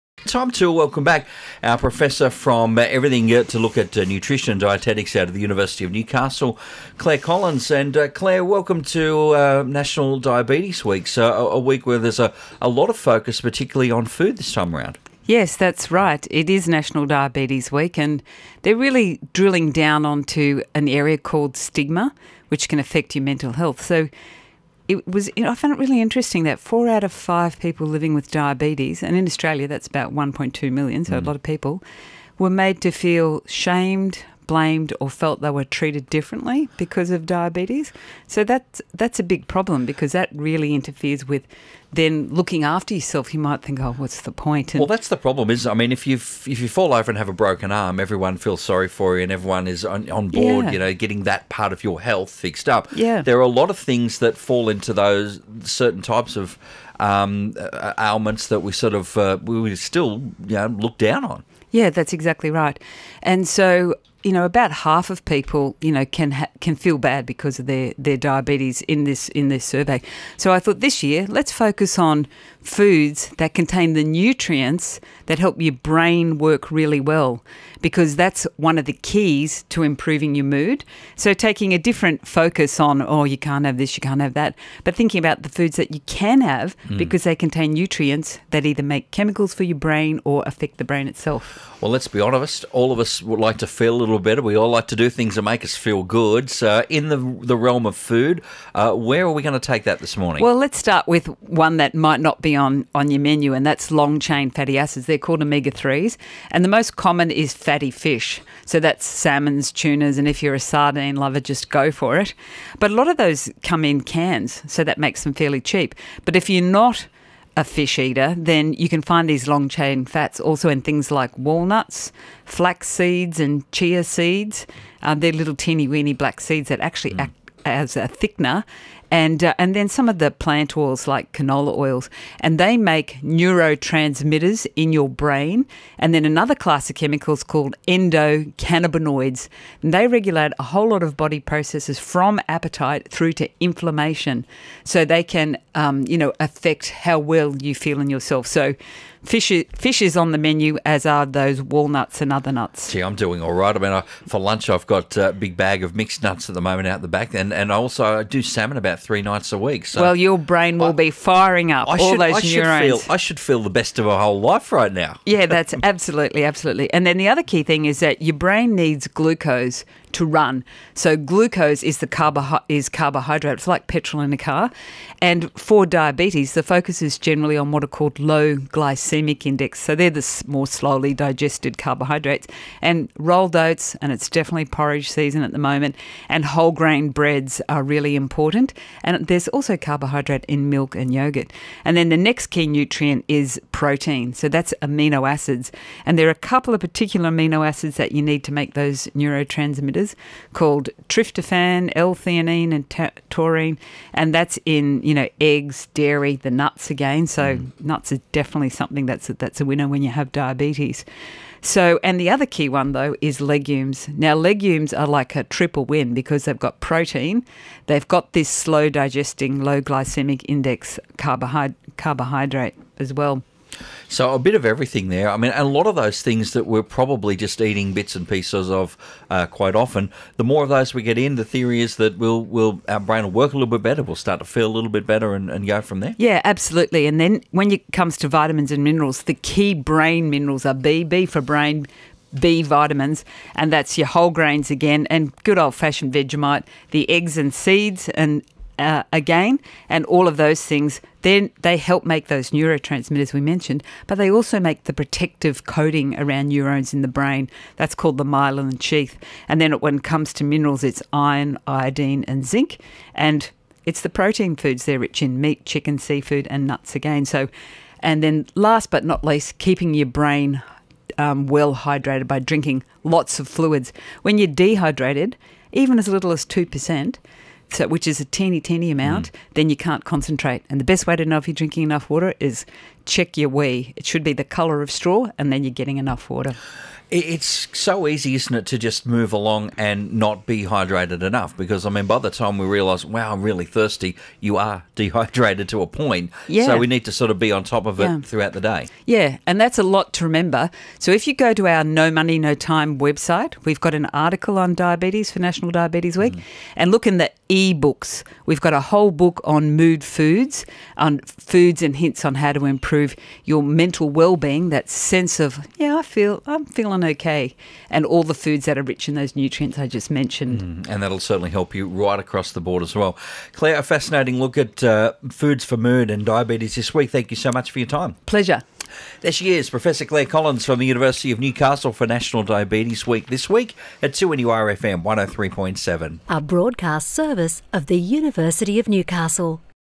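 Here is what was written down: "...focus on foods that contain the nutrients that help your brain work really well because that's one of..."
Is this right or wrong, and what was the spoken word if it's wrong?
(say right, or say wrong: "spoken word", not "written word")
right.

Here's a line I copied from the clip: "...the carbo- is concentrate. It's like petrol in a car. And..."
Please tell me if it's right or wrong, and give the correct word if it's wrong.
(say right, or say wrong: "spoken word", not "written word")
wrong: "carbohydrate", not "concentrate".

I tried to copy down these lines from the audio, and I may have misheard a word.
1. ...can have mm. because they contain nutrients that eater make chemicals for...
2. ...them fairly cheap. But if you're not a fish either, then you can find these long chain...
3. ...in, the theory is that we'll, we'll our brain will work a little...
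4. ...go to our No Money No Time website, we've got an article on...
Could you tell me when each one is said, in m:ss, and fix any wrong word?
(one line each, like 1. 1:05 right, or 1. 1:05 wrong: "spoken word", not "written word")
1. 1:26 wrong: "either", not "eater"
2. 1:55 wrong: "eater", not "either"
3. 3:51 right
4. 5:01 right.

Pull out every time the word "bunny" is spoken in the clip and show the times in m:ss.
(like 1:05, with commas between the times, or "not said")
not said.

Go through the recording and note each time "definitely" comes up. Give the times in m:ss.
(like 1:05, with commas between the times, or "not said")
3:04, 3:28.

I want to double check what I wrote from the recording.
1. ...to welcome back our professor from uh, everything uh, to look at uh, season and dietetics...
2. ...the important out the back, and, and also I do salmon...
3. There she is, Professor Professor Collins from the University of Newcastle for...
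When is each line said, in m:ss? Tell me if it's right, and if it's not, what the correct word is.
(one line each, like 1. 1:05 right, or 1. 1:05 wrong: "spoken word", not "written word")
1. 0:00 wrong: "nutrition", not "season"
2. 2:36 wrong: "moment", not "important"
3. 5:29 wrong: "Clare", not "Professor".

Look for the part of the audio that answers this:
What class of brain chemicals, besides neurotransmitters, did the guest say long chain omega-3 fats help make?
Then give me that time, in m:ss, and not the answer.
2:17.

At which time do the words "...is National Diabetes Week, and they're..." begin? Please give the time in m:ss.
0:16.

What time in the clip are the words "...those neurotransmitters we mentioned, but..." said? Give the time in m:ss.
4:12.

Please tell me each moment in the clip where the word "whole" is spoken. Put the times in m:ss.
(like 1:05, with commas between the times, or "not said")
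2:20, 2:44, 3:06, 4:04, 5:08.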